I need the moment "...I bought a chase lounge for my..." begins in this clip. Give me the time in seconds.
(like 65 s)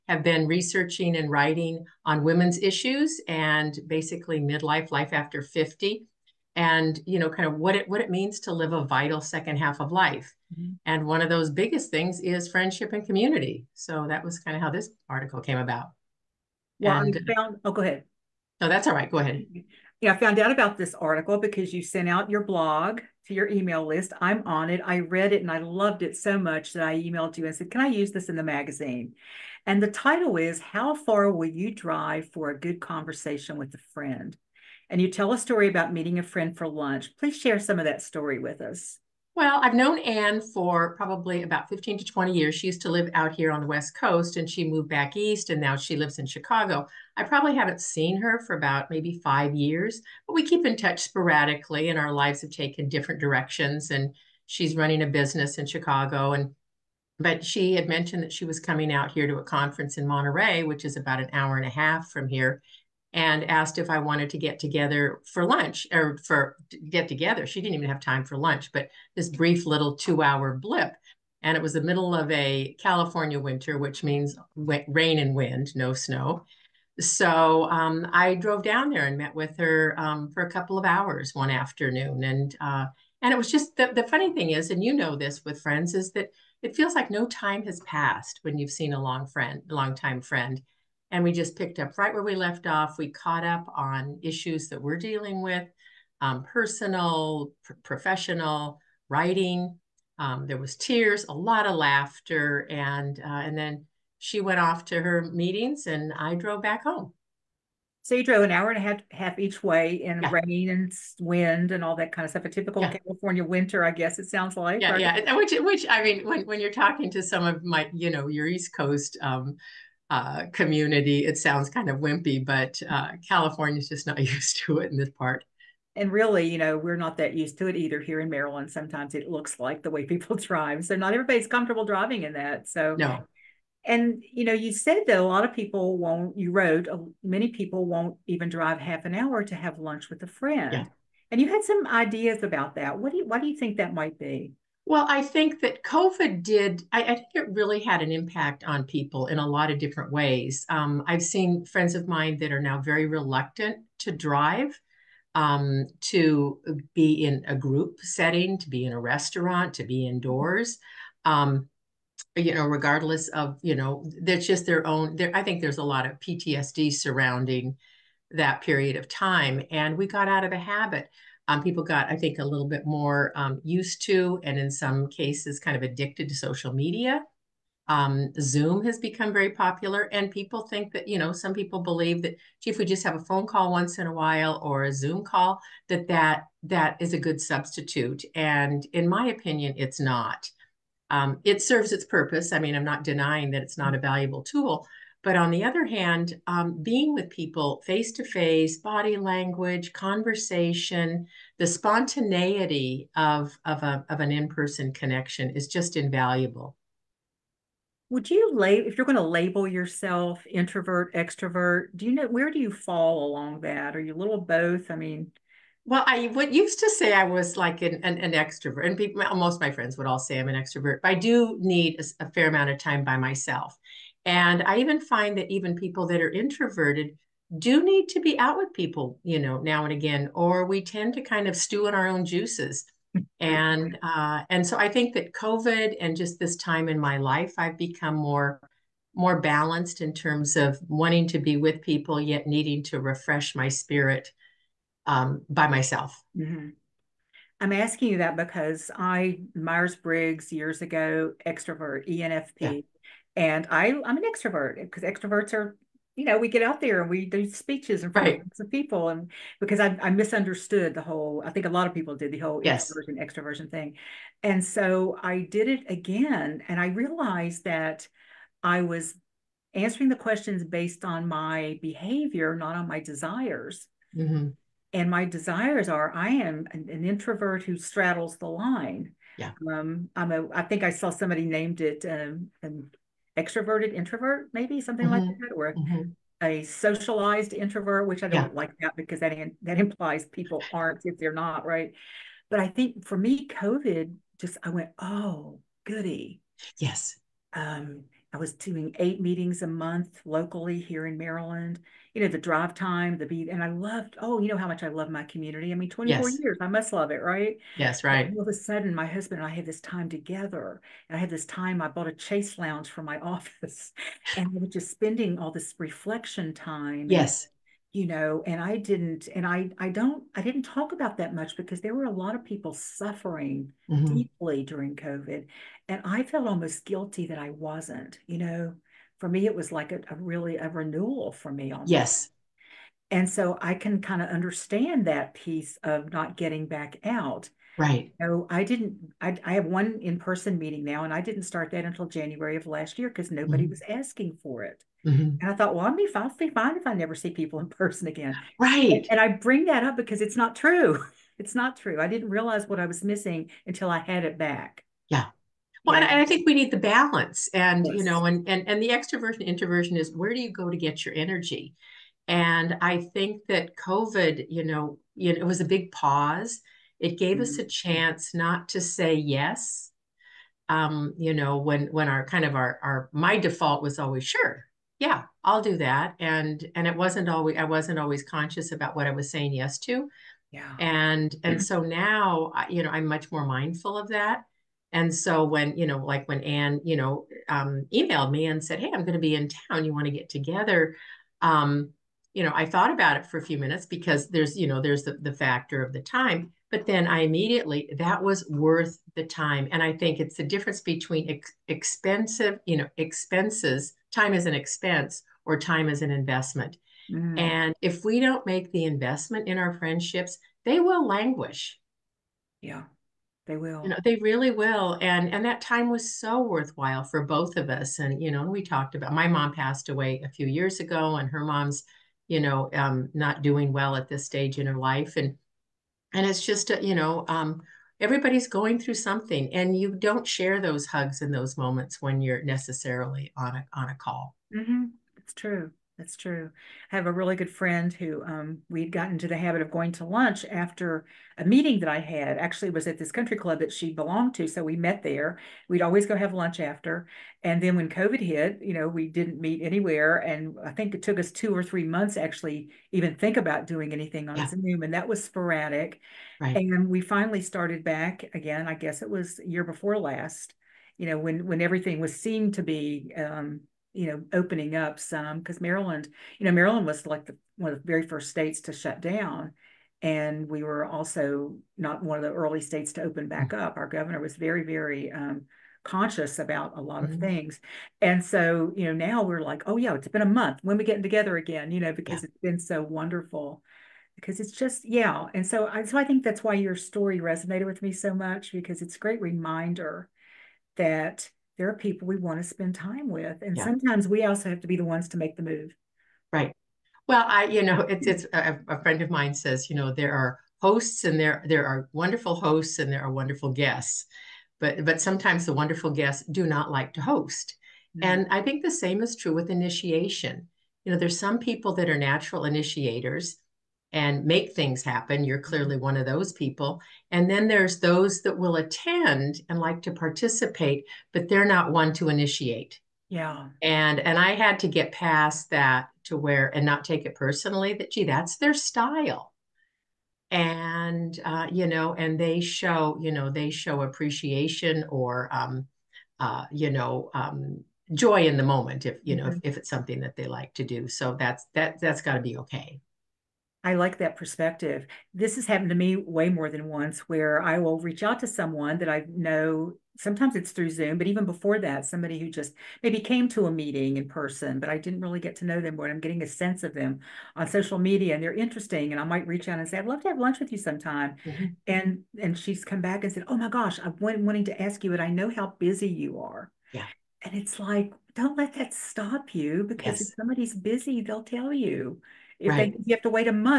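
311 s.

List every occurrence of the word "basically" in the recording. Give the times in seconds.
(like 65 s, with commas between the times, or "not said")
3 s.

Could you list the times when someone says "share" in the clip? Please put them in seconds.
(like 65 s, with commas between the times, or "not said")
37 s, 430 s.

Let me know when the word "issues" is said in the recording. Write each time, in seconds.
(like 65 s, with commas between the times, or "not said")
2 s, 94 s.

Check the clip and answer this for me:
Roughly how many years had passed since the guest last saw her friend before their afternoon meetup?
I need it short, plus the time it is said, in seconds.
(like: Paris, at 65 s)
5, at 49 s.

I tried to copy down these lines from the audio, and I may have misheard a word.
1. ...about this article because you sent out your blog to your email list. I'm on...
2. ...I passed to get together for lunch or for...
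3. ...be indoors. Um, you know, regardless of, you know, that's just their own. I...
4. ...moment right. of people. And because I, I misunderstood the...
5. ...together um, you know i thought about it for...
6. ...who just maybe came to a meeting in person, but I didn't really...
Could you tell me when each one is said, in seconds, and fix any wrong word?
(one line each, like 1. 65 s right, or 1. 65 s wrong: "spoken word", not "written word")
1. 20 s right
2. 63 s wrong: "wanted", not "passed"
3. 159 s right
4. 258 s wrong: "front", not "moment"
5. 390 s right
6. 552 s right.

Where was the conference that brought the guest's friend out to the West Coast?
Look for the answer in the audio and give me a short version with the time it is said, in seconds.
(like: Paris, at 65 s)
Monterey, at 60 s.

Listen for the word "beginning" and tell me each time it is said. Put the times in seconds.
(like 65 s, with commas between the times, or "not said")
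not said.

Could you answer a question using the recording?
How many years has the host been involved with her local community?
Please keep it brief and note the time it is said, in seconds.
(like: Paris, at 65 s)
24, at 305 s.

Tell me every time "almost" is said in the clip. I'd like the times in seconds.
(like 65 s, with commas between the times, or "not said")
326 s, 331 s.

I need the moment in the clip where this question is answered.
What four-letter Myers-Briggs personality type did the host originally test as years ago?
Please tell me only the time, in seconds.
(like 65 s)
252 s.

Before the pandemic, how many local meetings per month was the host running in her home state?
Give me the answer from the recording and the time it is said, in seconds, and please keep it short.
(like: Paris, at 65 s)
8, at 299 s.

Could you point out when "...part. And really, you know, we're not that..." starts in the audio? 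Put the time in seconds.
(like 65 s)
125 s.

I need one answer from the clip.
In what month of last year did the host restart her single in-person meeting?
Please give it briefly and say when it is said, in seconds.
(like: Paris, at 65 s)
January, at 342 s.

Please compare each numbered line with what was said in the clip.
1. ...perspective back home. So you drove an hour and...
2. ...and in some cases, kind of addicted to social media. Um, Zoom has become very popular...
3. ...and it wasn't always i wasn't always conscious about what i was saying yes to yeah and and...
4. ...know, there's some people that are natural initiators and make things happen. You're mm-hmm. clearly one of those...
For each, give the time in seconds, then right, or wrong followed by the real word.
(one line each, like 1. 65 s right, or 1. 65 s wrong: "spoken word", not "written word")
1. 106 s wrong: "drove", not "perspective"
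2. 174 s right
3. 376 s right
4. 510 s right.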